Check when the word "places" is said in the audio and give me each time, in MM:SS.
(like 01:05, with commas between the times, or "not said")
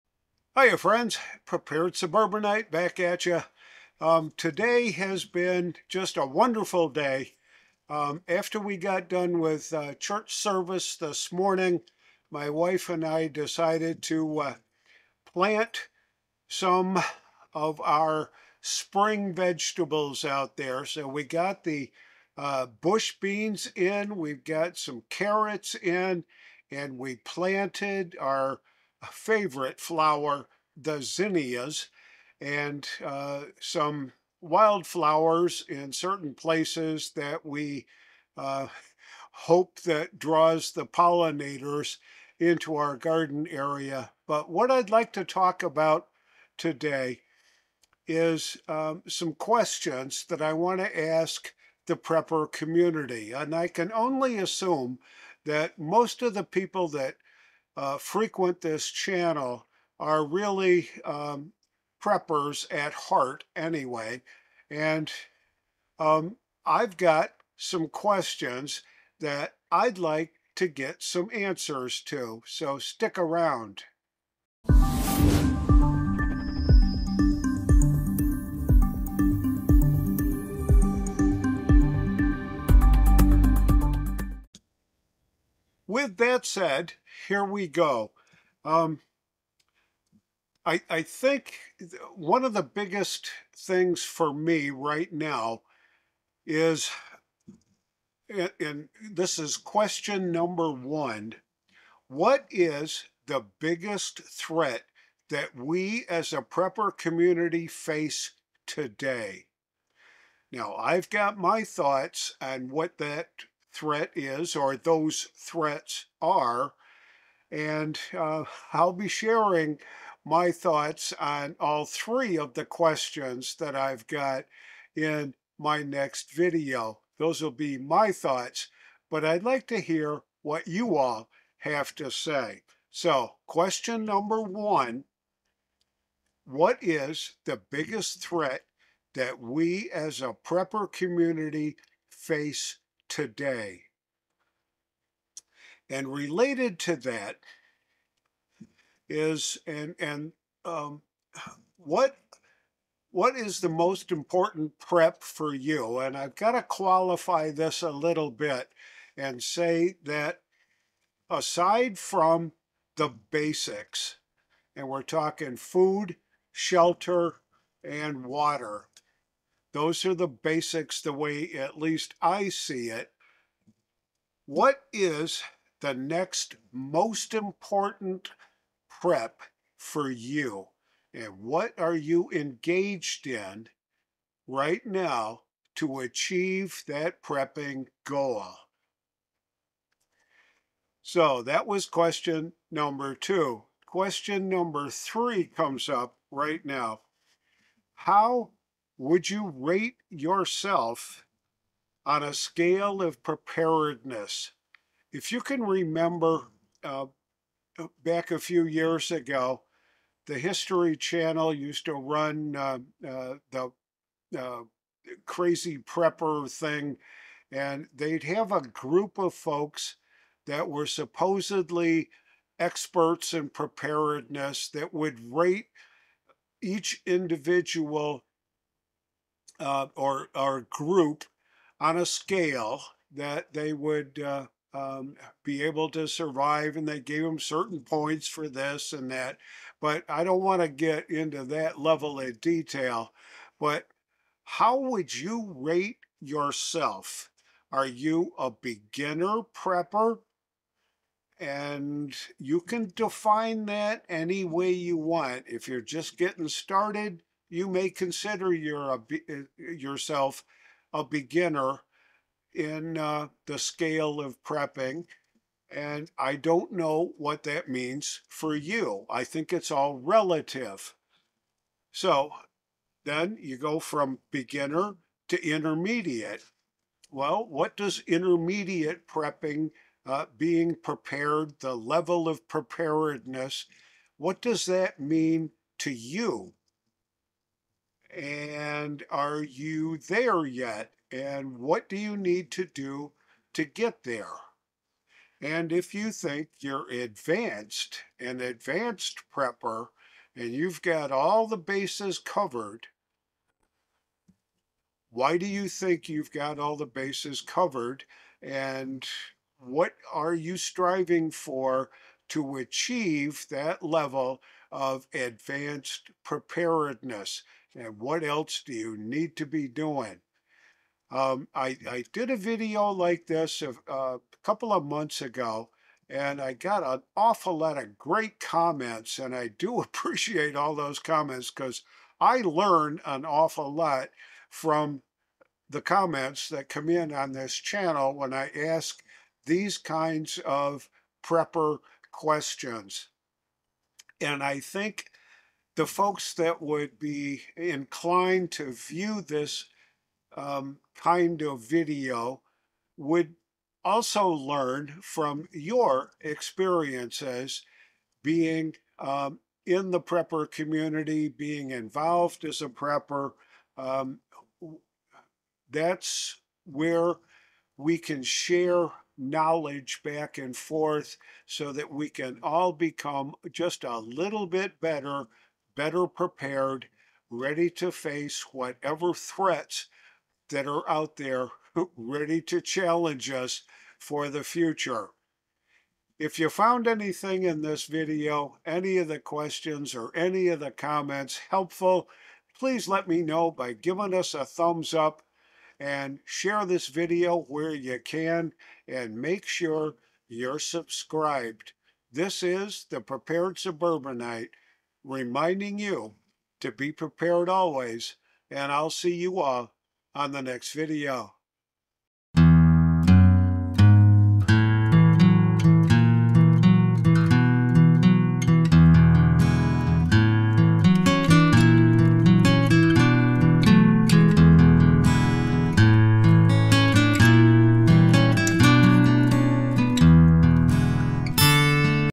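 00:36.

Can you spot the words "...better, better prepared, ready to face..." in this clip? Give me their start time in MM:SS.
06:14.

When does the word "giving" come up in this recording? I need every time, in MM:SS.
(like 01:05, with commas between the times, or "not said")
06:33.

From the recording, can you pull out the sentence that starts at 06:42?
This is the Prepared Suburbanite reminding you to be prepared always and I'll see you all on the next video.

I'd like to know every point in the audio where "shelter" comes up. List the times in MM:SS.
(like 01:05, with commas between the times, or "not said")
02:46.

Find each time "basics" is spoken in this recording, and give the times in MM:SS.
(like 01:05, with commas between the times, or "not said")
02:43, 02:50.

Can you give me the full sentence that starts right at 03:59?
But I don't want to get into that level of detail.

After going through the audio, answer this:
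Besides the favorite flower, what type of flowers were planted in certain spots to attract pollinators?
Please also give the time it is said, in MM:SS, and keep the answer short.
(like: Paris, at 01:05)
Wildflowers, at 00:34.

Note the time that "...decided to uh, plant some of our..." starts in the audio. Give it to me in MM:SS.
00:13.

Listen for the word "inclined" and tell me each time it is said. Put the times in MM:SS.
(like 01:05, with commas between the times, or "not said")
05:47.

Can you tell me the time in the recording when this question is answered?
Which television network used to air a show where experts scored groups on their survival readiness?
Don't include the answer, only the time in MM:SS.
03:30.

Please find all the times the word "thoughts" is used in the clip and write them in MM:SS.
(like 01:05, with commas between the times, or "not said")
01:51, 02:00, 02:08.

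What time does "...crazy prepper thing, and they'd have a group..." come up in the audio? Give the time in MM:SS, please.
03:35.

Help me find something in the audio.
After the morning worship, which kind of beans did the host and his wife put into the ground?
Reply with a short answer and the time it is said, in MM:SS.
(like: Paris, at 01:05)
Bush beans, at 00:22.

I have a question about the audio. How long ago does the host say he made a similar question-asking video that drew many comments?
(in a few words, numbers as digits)
A couple of months.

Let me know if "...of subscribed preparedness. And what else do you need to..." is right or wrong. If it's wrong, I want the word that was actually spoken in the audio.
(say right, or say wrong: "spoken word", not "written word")
wrong: "advanced", not "subscribed".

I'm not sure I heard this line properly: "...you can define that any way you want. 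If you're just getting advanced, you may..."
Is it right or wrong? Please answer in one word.
wrong.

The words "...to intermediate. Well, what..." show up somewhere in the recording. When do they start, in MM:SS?
04:35.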